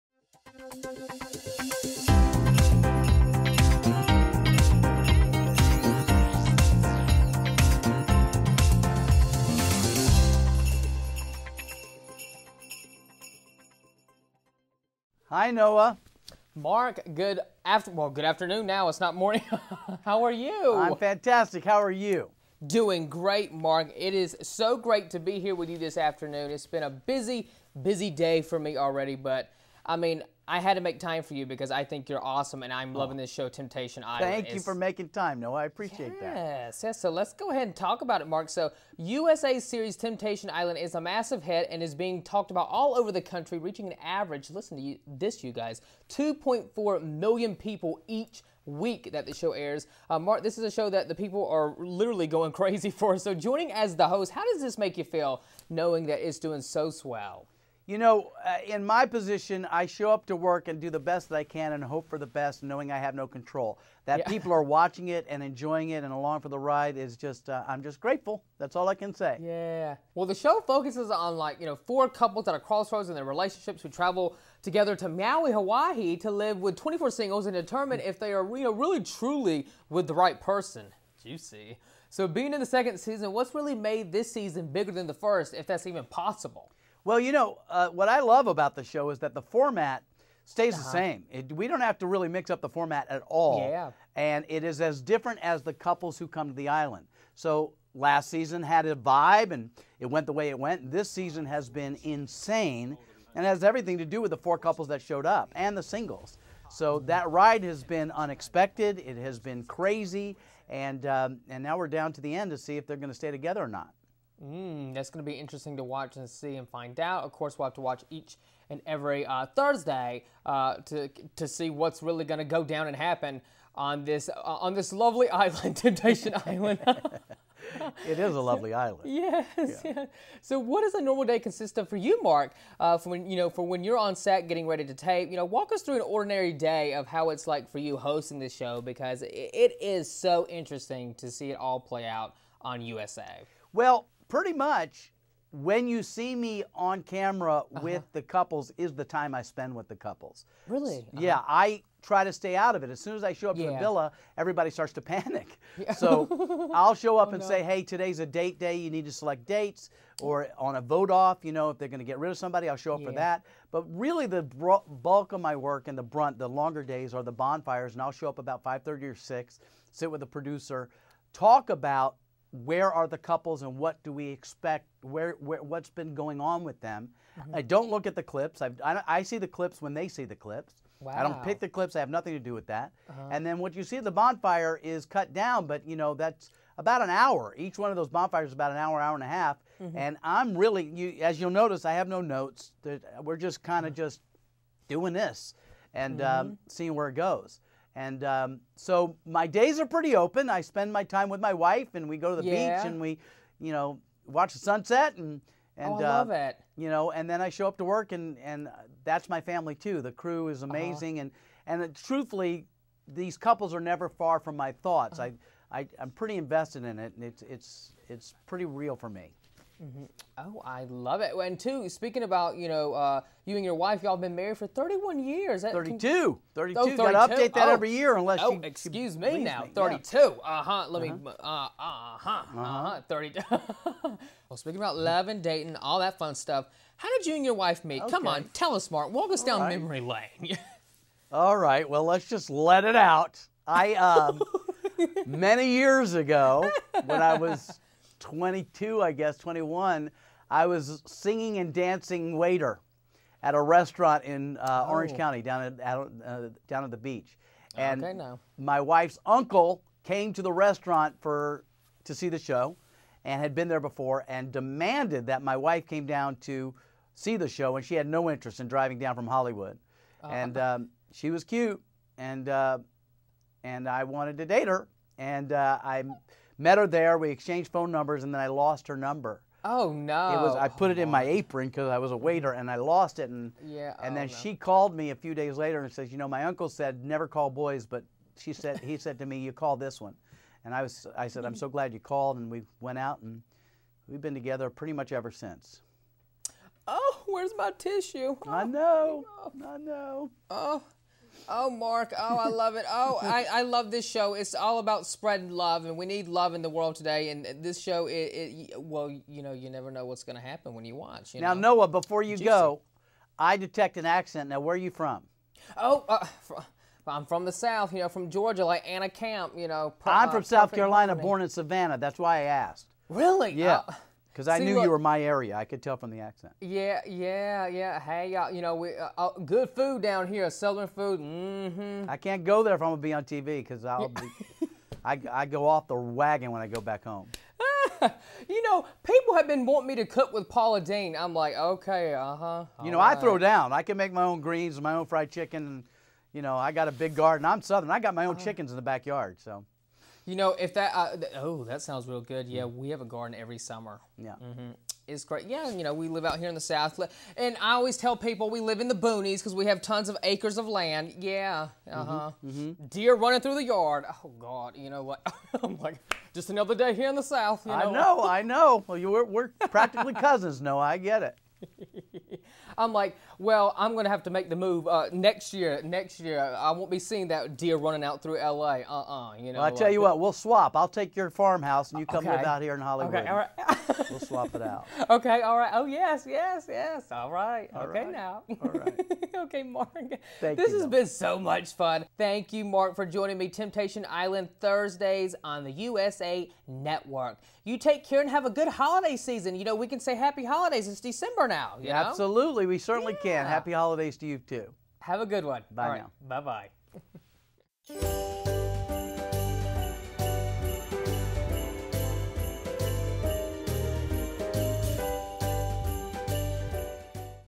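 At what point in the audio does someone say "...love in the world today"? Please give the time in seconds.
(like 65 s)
306 s.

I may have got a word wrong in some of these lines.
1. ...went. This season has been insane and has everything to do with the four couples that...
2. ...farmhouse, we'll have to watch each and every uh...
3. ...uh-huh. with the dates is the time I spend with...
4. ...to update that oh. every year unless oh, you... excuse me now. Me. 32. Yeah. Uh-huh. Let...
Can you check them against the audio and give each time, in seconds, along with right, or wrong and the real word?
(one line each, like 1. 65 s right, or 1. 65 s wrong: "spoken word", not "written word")
1. 100 s right
2. 117 s wrong: "course", not "farmhouse"
3. 147 s wrong: "couples", not "dates"
4. 227 s right.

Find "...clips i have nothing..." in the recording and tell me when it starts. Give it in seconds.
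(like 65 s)
181 s.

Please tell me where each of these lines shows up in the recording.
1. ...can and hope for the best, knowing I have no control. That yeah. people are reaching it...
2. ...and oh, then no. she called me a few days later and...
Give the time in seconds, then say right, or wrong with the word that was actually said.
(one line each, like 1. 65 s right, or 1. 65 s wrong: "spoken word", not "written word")
1. 61 s wrong: "watching", not "reaching"
2. 284 s right.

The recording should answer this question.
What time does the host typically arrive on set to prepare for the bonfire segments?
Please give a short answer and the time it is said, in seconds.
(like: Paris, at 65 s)
5:30 or 6, at 168 s.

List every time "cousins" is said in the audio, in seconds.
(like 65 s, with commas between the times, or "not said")
370 s.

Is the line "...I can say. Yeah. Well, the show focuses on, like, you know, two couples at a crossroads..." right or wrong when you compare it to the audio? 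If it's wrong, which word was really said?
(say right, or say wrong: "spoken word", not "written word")
wrong: "four", not "two".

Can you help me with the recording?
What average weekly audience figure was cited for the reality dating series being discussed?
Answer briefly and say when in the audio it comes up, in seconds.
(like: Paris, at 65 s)
2.4 million, at 46 s.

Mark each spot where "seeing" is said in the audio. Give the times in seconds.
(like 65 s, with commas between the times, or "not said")
196 s, 376 s.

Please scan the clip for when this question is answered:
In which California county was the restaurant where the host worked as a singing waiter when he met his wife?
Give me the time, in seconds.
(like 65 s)
254 s.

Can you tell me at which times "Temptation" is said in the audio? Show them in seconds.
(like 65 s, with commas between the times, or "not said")
33 s, 39 s, 125 s, 393 s.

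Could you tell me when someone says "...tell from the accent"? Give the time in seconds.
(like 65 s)
325 s.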